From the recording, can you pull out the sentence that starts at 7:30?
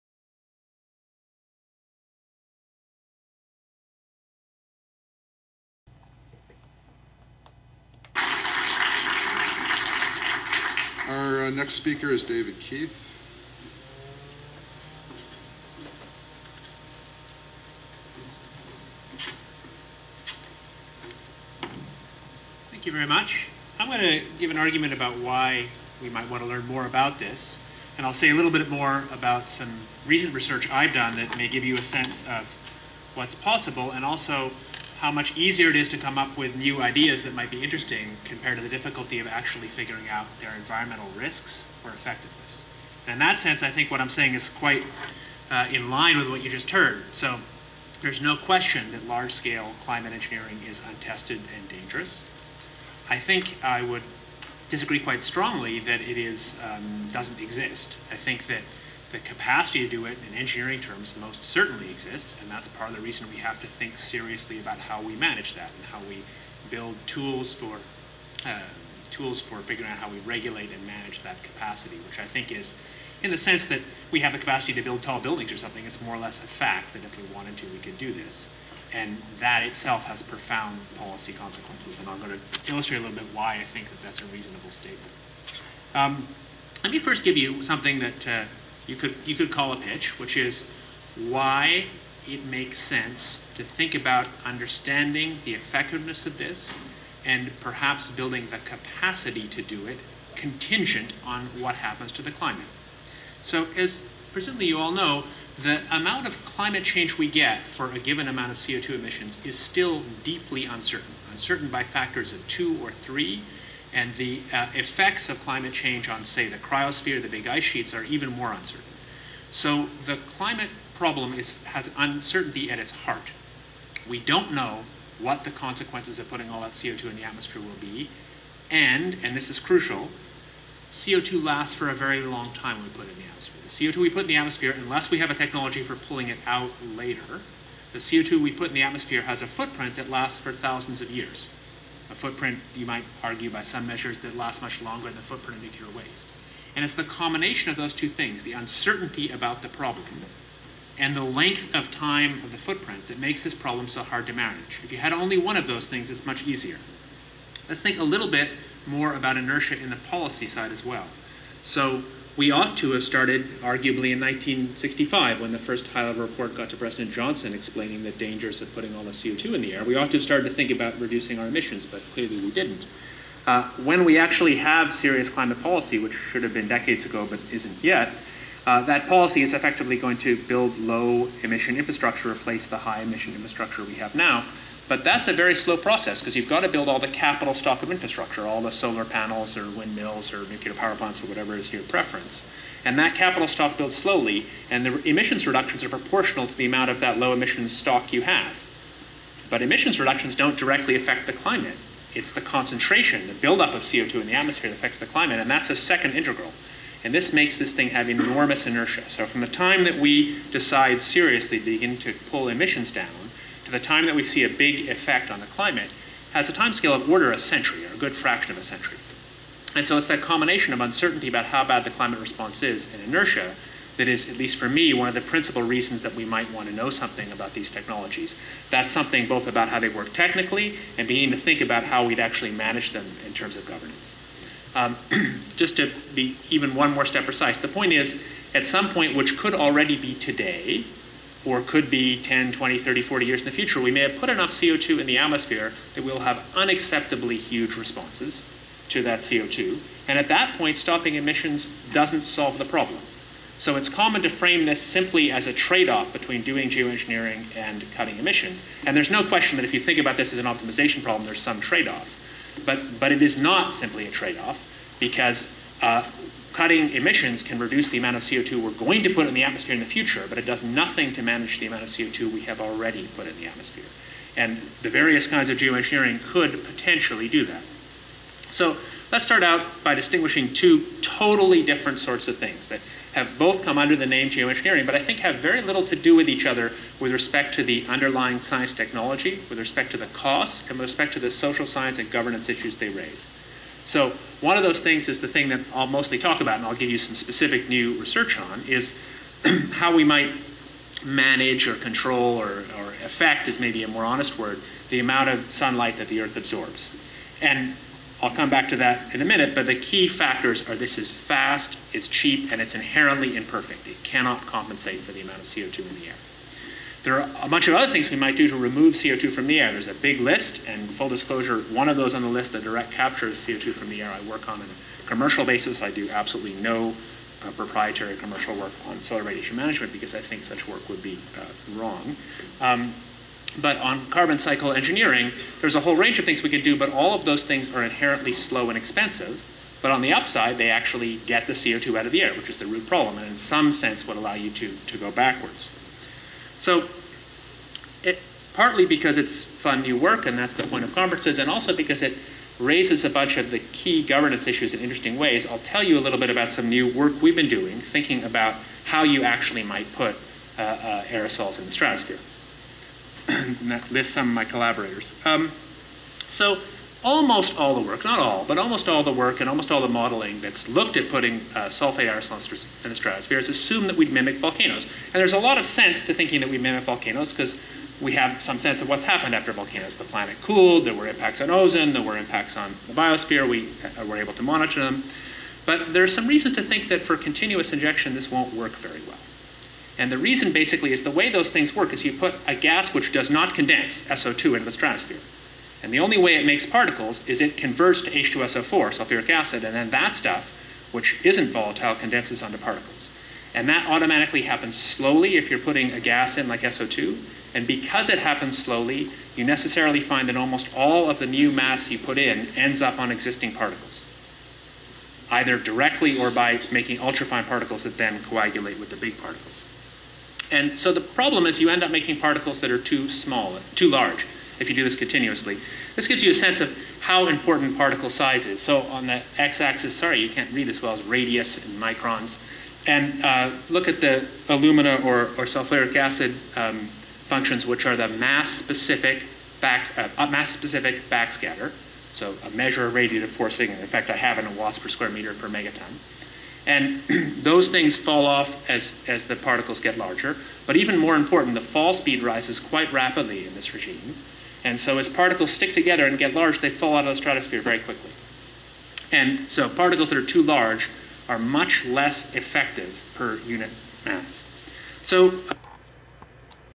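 But even more important, the fall speed rises quite rapidly in this regime.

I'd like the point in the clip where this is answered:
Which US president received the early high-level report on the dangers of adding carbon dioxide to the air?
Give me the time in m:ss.
2:46.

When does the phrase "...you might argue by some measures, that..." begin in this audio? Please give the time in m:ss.
2:22.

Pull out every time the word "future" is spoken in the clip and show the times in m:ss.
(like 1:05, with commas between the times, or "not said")
4:03, 4:29.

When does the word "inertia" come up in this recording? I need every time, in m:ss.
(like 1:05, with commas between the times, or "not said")
2:39, 3:28, 3:43.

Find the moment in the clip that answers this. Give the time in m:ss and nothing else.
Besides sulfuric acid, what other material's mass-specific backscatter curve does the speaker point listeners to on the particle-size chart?
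7:14.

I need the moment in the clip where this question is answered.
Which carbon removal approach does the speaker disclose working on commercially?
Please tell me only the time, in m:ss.
5:22.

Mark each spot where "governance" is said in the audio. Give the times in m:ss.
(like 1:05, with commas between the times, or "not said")
3:53, 4:52, 5:54.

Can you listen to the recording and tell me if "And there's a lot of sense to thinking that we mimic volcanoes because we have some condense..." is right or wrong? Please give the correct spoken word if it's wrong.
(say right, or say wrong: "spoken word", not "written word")
wrong: "sense", not "condense".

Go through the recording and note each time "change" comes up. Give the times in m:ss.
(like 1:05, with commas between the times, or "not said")
1:46, 1:55.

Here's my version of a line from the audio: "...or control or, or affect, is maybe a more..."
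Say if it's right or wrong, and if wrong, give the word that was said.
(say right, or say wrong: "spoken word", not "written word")
right.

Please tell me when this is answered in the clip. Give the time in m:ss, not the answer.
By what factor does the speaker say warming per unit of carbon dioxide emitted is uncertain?
1:51.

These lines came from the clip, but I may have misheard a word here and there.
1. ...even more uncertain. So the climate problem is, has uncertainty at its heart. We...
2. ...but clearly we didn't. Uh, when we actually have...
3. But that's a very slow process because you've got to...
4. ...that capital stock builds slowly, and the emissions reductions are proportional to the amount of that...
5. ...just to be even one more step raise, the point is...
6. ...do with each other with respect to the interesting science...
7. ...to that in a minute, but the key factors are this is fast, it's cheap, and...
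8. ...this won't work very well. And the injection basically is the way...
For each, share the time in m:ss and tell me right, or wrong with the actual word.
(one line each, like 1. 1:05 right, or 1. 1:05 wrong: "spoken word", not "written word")
1. 1:58 right
2. 2:51 right
3. 3:04 right
4. 3:12 right
5. 3:55 wrong: "precise", not "raise"
6. 4:45 wrong: "underlying", not "interesting"
7. 5:08 right
8. 6:28 wrong: "reason", not "injection".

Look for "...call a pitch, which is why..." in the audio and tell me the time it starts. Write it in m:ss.
1:29.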